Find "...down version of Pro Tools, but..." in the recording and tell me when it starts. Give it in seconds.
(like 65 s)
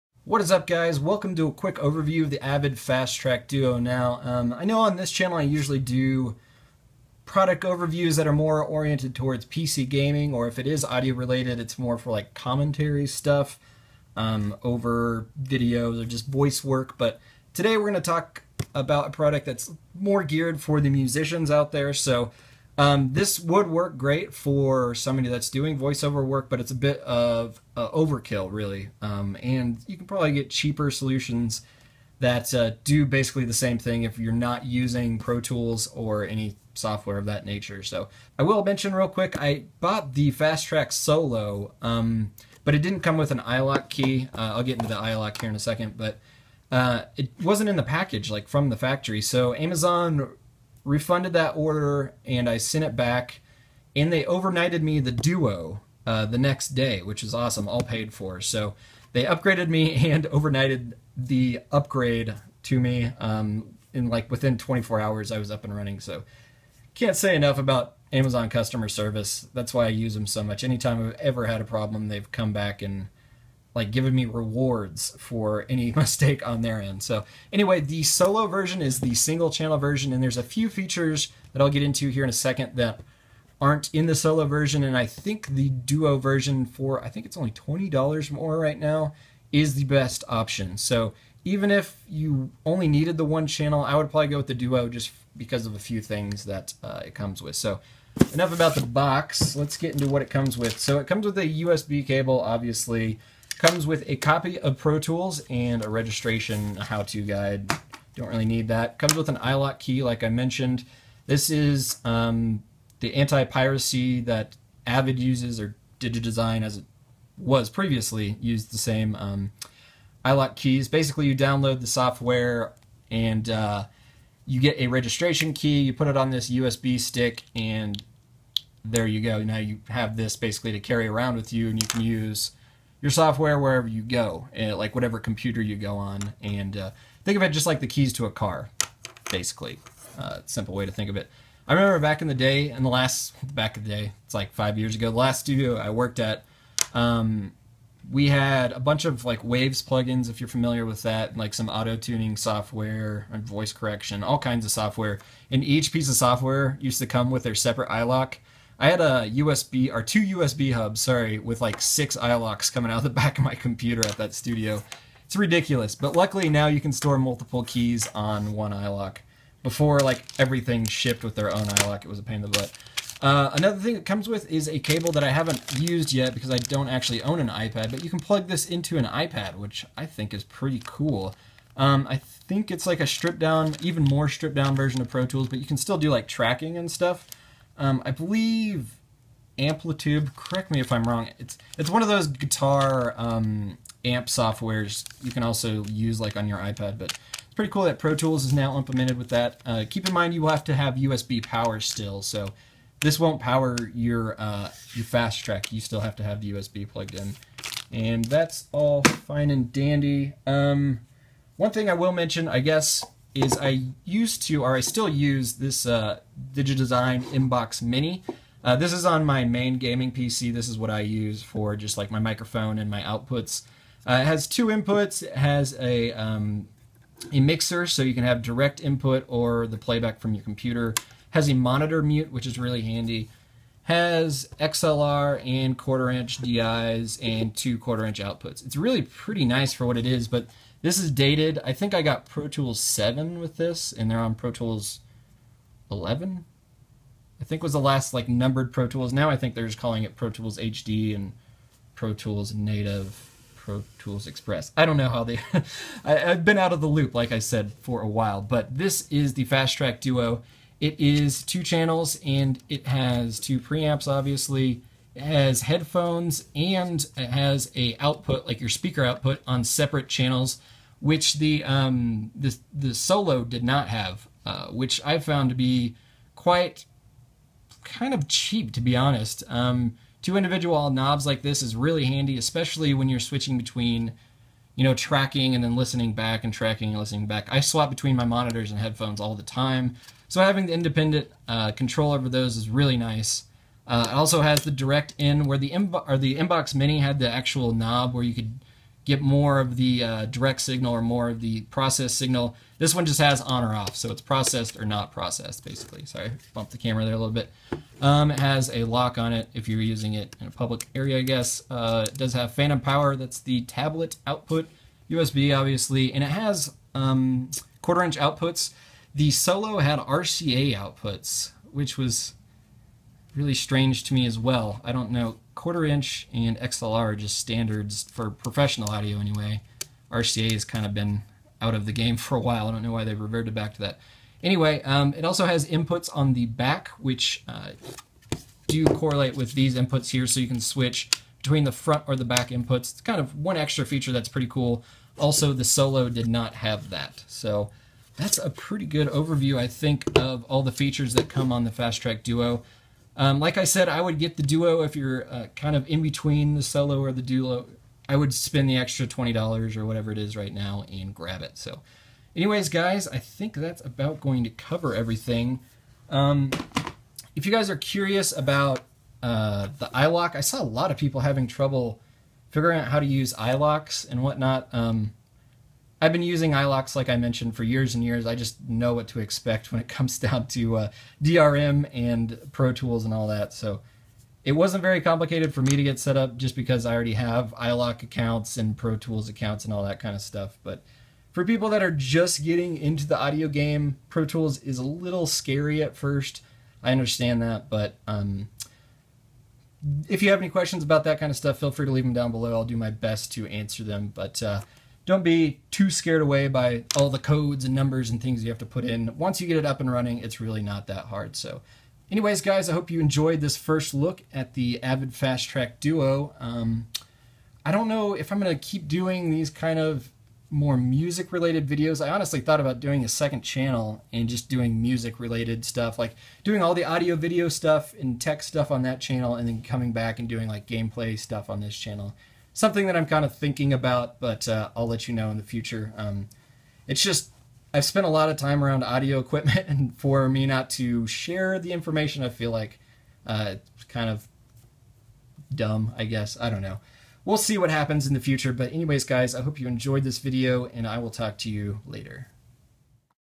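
184 s.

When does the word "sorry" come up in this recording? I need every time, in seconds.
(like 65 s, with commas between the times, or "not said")
161 s, 306 s.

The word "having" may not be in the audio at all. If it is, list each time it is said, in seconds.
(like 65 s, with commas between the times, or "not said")
290 s, 371 s.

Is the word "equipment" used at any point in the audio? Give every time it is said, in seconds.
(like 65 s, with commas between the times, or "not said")
439 s.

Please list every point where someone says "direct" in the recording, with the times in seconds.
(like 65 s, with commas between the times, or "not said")
228 s, 294 s, 300 s.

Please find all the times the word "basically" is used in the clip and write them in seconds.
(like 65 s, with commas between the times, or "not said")
33 s, 120 s, 130 s, 139 s, 305 s.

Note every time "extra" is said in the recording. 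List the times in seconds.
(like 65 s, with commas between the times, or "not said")
343 s, 358 s.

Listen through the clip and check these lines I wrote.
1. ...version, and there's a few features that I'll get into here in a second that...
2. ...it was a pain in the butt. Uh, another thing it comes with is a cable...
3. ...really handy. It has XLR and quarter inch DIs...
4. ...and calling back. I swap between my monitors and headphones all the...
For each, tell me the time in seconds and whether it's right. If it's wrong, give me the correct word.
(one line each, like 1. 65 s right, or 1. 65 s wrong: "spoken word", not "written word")
1. 79 s right
2. 172 s right
3. 232 s right
4. 286 s wrong: "listening", not "calling".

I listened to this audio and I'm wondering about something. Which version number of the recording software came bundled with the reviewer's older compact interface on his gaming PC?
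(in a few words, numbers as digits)
Pro Tools 7.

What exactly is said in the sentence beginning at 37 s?
So I will mention real quick, I bought the Fast Track Solo, um, but it didn't come with an iLok key.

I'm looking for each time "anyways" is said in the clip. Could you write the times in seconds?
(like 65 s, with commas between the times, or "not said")
77 s, 329 s, 334 s, 362 s, 412 s, 448 s.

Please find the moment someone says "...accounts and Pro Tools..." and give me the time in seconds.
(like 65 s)
388 s.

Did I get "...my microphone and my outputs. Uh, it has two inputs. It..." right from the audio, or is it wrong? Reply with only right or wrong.
right.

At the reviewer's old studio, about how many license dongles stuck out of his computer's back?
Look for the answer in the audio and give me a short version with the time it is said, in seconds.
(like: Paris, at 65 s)
6, at 161 s.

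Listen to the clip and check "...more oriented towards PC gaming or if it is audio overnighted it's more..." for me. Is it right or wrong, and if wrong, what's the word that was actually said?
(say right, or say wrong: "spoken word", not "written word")
wrong: "related", not "overnighted".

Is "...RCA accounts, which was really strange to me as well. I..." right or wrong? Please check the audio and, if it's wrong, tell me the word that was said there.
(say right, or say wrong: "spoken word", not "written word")
wrong: "outputs", not "accounts".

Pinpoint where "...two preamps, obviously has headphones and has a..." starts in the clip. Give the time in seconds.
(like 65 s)
263 s.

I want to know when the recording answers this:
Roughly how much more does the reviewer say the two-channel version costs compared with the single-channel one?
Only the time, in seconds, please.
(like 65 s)
87 s.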